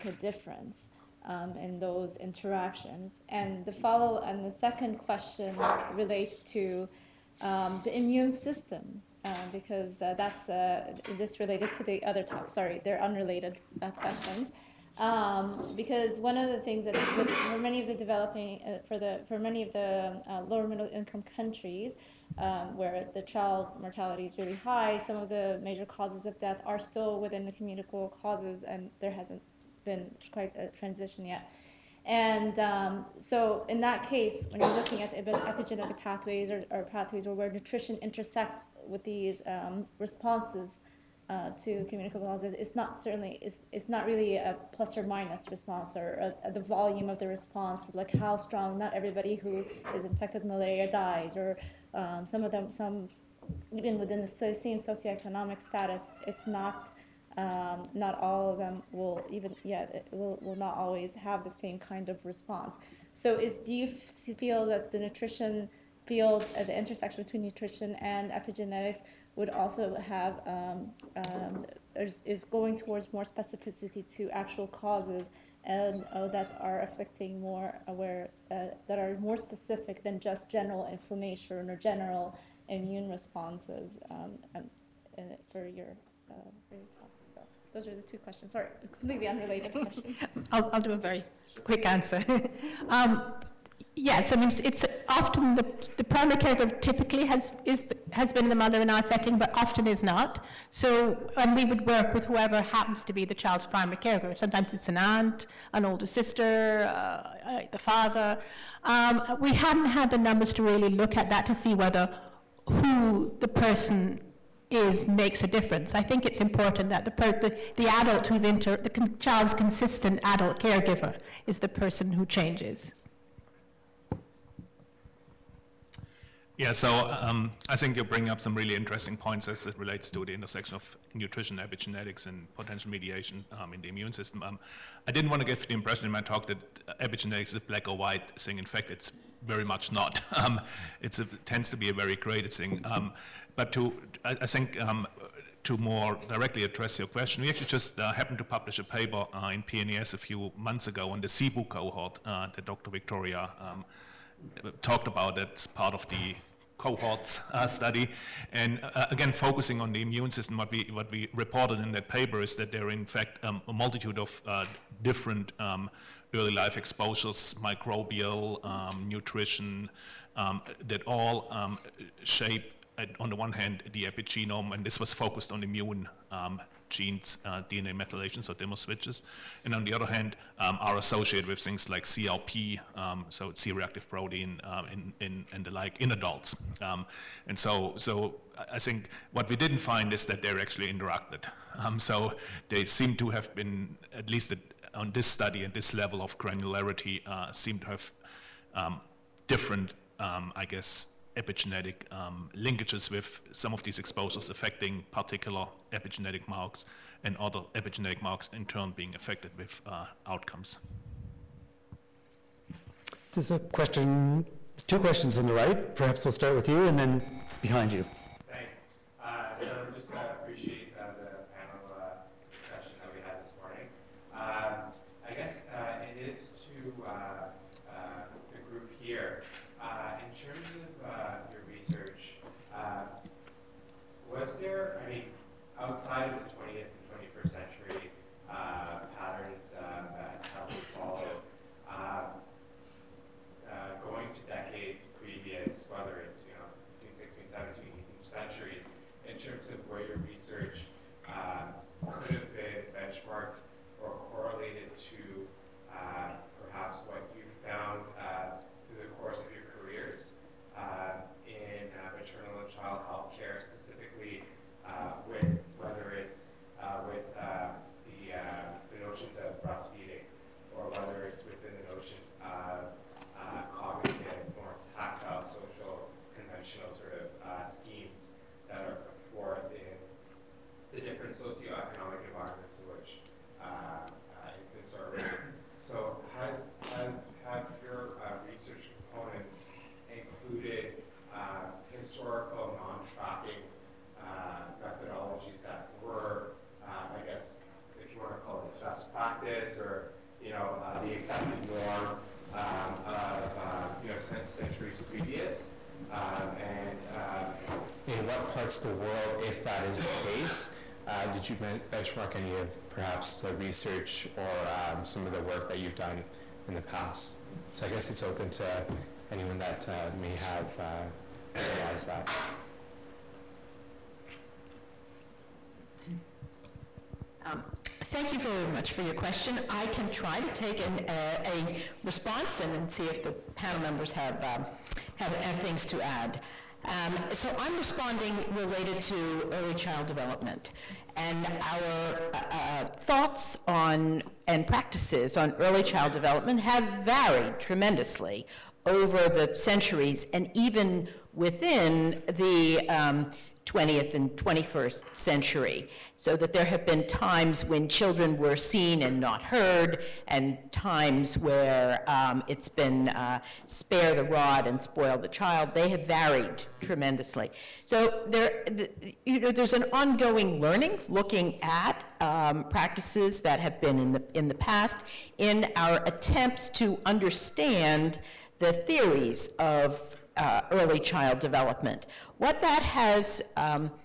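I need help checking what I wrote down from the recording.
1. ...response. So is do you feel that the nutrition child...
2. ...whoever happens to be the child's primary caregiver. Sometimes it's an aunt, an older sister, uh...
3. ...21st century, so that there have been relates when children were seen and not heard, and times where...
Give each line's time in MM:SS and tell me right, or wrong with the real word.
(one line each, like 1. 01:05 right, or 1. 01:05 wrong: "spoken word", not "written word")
1. 01:02 wrong: "field", not "child"
2. 01:42 right
3. 05:54 wrong: "times", not "relates".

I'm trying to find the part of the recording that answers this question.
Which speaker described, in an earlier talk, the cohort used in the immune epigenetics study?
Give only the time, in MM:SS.
02:32.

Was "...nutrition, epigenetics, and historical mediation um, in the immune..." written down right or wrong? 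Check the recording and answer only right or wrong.
wrong.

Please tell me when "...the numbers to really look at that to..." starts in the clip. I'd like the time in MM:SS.
01:50.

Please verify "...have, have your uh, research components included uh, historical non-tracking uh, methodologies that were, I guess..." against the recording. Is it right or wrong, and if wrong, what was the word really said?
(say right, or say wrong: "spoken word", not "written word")
right.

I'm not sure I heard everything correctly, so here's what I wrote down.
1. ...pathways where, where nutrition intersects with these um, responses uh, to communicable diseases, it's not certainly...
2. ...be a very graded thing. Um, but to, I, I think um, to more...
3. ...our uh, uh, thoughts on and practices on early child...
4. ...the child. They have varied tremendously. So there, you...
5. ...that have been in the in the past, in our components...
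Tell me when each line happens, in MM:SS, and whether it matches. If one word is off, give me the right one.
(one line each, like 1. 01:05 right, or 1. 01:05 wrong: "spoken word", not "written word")
1. 00:36 right
2. 02:21 right
3. 05:41 right
4. 06:05 right
5. 06:13 wrong: "attempts", not "components".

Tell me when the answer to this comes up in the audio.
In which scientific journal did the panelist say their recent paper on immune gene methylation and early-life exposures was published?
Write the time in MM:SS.
02:29.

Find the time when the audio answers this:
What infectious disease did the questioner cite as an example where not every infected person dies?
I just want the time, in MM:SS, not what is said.
00:50.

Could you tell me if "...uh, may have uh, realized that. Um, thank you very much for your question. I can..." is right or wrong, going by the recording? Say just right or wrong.
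right.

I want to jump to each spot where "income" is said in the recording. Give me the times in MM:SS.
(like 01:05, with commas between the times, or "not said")
00:20.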